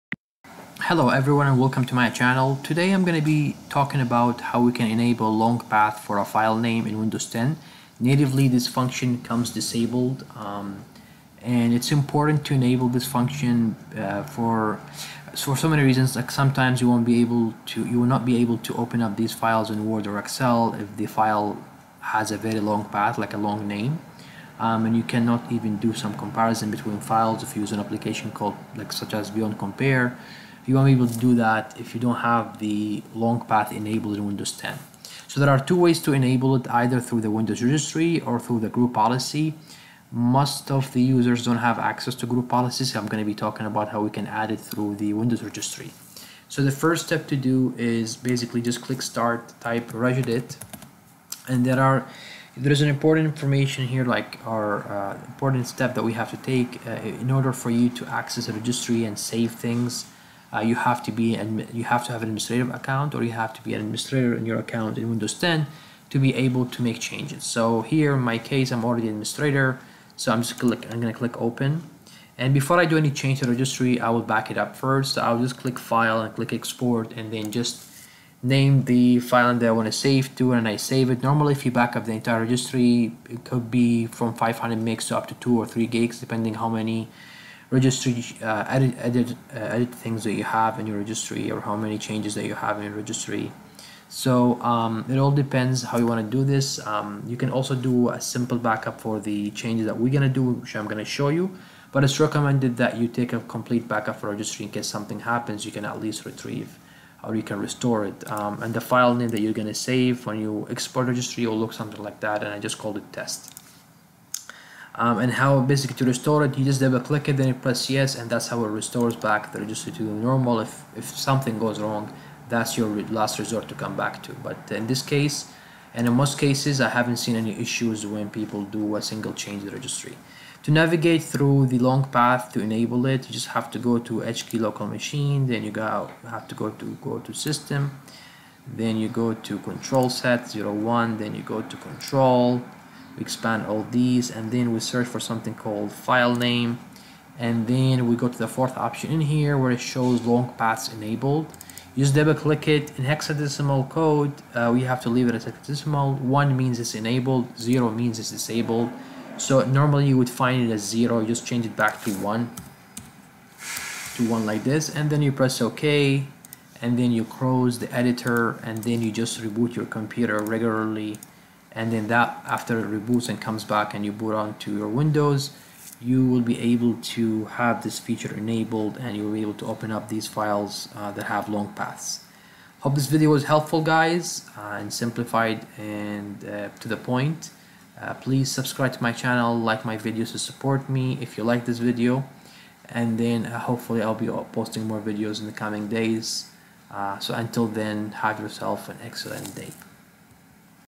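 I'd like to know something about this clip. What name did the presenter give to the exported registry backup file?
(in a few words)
test.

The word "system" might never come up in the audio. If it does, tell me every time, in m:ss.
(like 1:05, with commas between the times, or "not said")
2:17.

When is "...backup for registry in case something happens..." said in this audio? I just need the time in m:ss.
1:43.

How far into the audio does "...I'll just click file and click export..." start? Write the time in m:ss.
1:15.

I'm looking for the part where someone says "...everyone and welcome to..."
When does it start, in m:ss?
0:01.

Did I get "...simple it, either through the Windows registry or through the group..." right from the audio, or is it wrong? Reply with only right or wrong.
wrong.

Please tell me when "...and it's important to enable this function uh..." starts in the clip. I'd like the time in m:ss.
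0:11.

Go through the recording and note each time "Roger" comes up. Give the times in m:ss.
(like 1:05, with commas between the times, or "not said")
not said.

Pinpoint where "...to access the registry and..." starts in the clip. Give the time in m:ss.
0:57.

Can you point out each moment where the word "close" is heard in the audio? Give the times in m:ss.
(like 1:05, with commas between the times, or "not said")
2:47.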